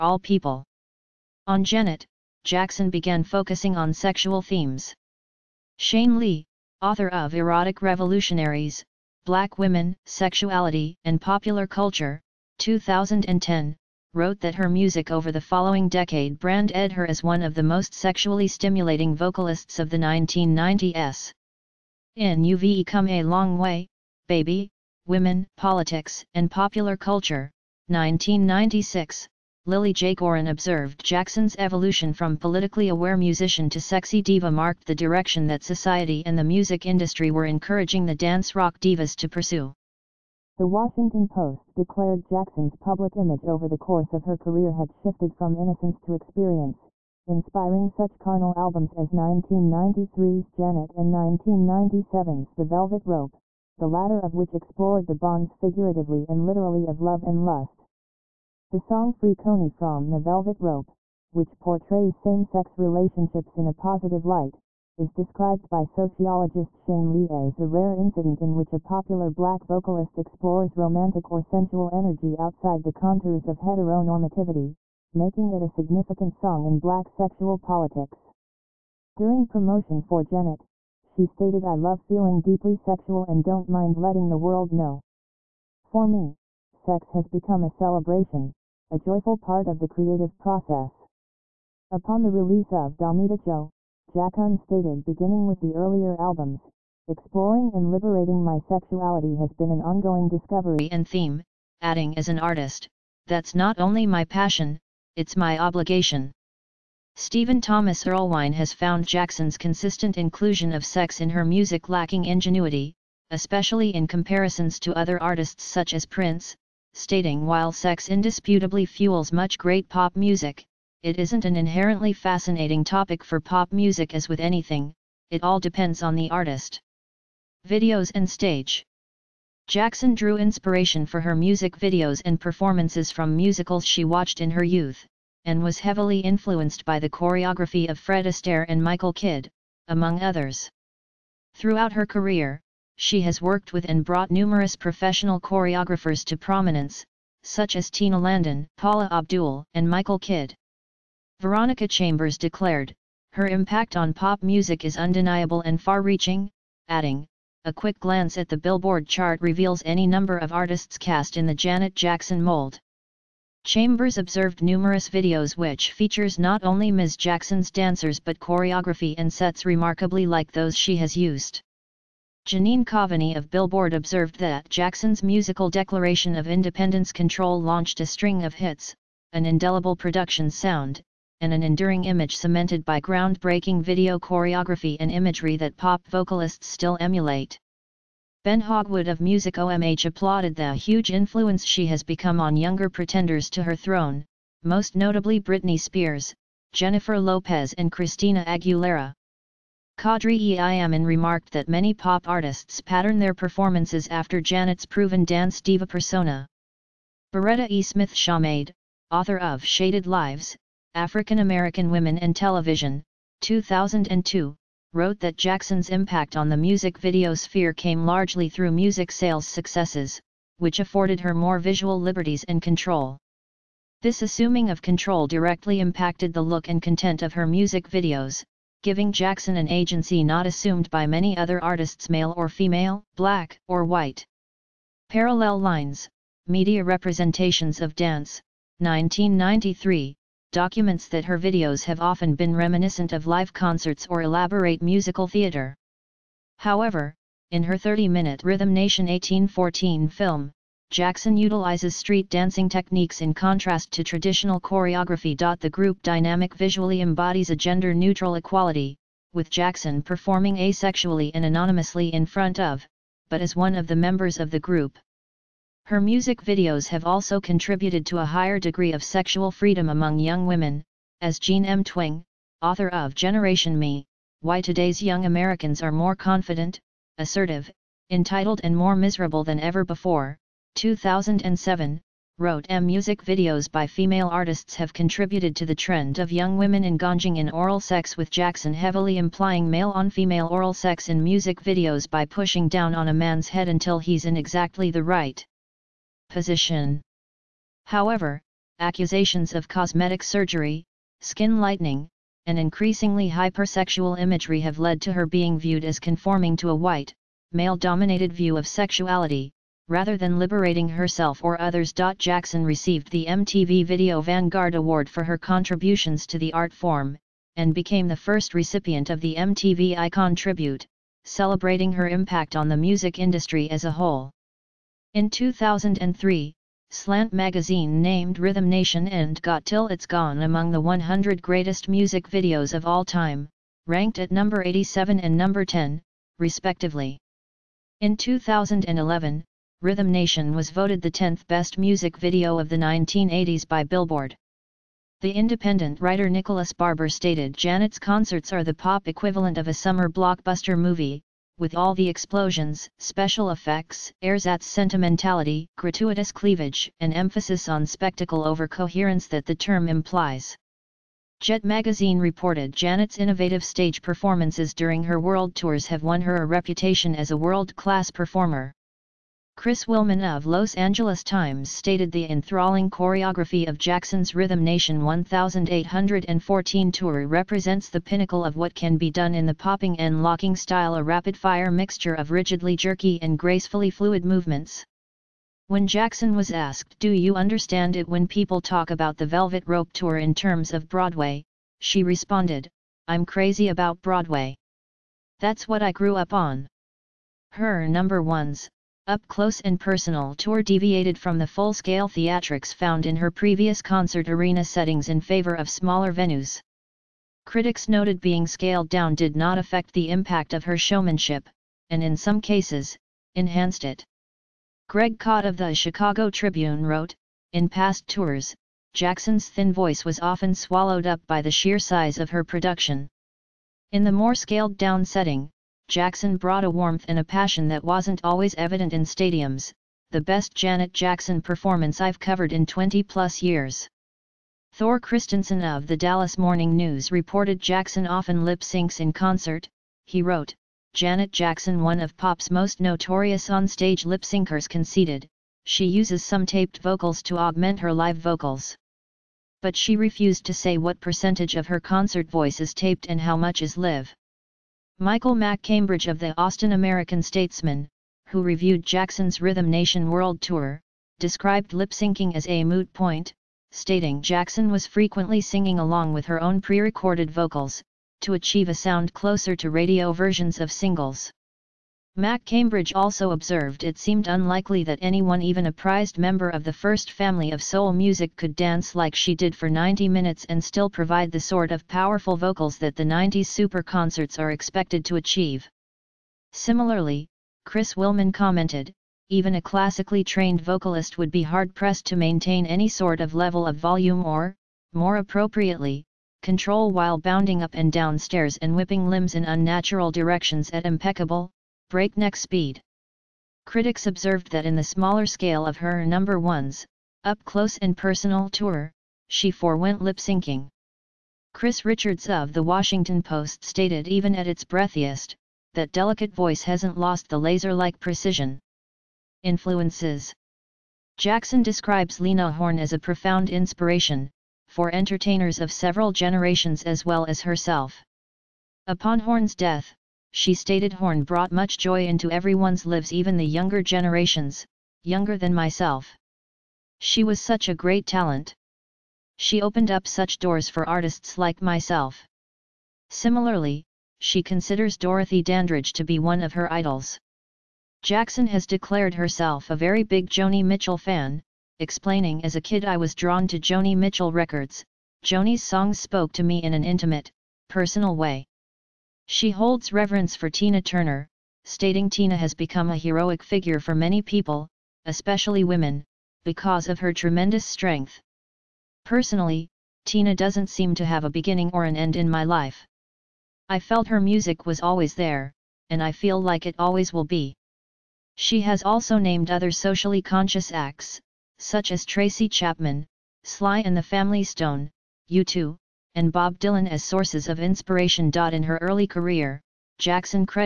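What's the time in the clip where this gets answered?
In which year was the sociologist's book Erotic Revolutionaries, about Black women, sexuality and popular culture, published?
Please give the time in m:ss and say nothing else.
0:12.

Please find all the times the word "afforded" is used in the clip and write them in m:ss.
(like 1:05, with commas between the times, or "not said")
3:40.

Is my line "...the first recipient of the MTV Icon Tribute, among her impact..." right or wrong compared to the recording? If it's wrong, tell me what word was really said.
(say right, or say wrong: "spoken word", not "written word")
wrong: "celebrating", not "among".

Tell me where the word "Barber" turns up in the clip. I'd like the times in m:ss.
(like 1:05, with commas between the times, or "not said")
5:46.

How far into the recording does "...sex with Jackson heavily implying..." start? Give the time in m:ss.
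4:47.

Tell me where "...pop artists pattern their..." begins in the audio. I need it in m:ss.
3:21.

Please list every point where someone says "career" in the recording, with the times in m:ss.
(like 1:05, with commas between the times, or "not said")
0:44, 2:22, 9:49.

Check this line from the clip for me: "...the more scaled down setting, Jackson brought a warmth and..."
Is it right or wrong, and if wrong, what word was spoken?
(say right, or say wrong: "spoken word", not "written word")
right.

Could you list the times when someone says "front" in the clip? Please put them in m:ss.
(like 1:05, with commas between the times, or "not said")
4:22.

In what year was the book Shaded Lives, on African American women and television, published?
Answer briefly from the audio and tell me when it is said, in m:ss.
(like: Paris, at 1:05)
2002, at 3:33.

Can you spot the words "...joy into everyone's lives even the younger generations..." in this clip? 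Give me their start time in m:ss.
8:51.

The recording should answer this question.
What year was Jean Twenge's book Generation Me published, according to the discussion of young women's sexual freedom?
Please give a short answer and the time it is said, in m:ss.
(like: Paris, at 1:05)
2007, at 4:40.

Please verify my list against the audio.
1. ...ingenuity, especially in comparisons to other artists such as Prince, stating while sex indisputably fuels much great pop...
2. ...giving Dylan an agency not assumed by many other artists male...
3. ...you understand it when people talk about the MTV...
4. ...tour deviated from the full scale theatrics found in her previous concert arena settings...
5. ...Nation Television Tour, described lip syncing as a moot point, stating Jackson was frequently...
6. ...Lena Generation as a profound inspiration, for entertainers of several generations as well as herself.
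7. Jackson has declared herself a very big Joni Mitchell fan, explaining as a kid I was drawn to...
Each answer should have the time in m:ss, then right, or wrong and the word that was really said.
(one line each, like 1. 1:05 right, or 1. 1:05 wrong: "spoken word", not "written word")
1. 1:52 right
2. 3:48 wrong: "Jackson", not "Dylan"
3. 6:27 wrong: "Velvet", not "MTV"
4. 6:40 right
5. 7:39 wrong: "World", not "Television"
6. 8:42 wrong: "Horne", not "Generation"
7. 9:08 right.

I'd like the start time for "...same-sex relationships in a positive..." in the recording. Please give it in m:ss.
1:02.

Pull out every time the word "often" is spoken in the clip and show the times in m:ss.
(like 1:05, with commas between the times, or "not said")
4:01, 7:00, 7:18.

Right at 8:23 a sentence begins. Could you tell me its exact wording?
Critics observed that in the smaller scale of her number ones, up close and personal tour, she forewent lip syncing.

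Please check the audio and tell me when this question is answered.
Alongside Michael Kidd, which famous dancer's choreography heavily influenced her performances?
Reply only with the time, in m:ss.
2:17.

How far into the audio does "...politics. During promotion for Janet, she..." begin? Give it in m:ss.
1:17.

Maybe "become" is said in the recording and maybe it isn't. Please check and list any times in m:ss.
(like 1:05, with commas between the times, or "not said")
1:27, 3:12, 9:22.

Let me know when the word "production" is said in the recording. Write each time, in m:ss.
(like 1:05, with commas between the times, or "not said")
2:59, 7:02.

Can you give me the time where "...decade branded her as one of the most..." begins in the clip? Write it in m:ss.
0:15.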